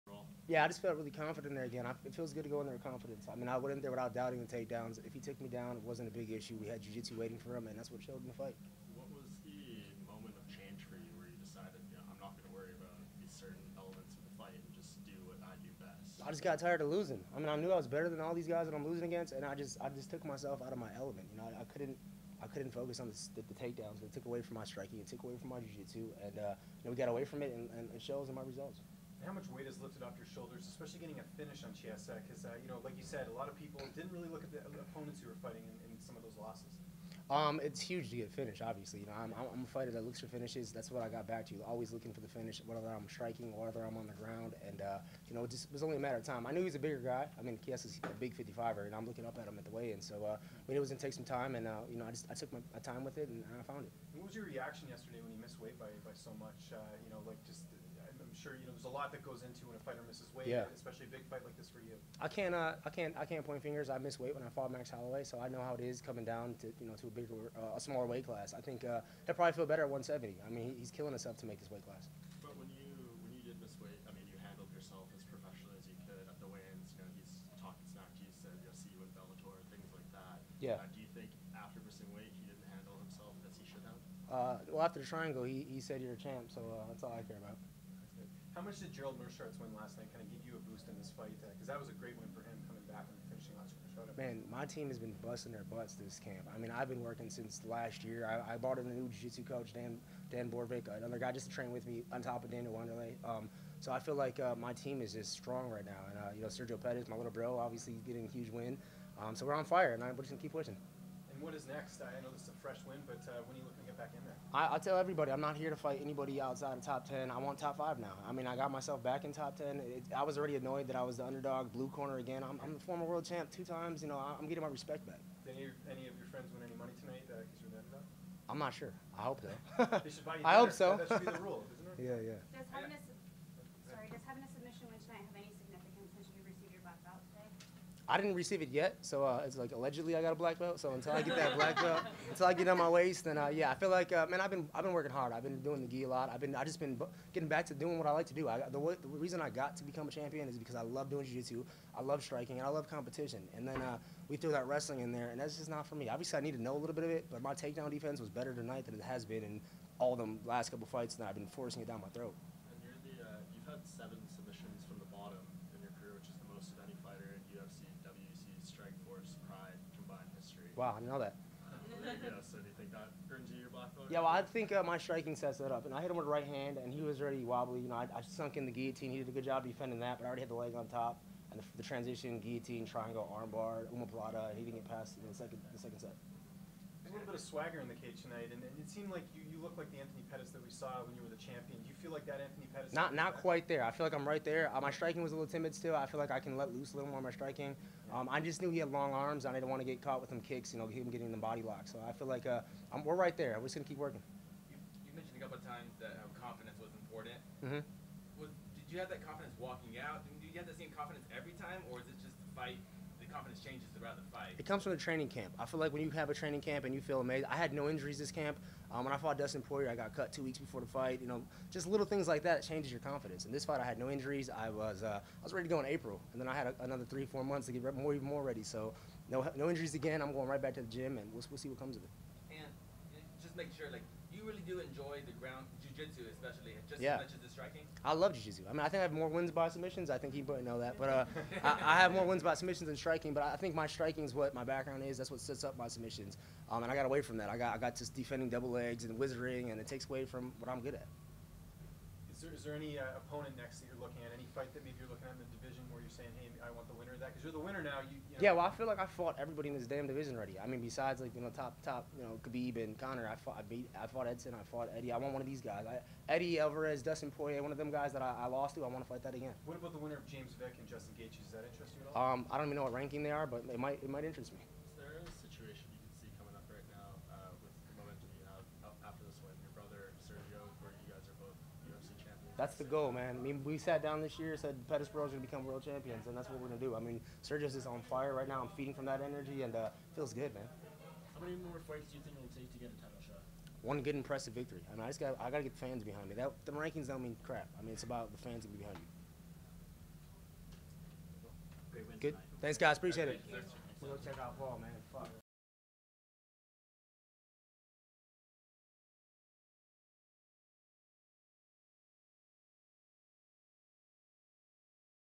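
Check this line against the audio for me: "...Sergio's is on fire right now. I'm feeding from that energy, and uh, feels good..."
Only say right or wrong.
right.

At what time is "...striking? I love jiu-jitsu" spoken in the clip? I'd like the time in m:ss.
3:57.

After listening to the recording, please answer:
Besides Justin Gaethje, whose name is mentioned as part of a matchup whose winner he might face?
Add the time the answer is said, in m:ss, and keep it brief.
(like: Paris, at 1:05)
James Vick, at 4:30.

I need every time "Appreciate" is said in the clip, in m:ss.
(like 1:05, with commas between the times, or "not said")
5:02.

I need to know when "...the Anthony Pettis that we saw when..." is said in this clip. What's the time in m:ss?
3:09.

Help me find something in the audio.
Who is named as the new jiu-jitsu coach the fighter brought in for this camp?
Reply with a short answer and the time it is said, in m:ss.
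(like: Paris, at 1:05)
Dan Borvik, at 1:40.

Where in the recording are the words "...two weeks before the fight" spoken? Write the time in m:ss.
3:40.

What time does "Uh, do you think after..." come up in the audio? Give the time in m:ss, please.
1:20.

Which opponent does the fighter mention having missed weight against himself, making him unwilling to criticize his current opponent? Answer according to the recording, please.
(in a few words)
Max Holloway.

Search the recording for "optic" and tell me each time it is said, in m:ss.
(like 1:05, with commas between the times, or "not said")
not said.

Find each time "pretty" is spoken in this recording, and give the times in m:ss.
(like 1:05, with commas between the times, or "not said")
not said.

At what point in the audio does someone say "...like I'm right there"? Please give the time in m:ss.
3:14.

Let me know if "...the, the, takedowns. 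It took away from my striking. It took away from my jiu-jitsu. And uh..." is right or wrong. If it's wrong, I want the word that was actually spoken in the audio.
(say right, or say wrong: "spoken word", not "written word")
right.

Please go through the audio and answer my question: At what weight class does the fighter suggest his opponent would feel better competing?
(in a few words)
170.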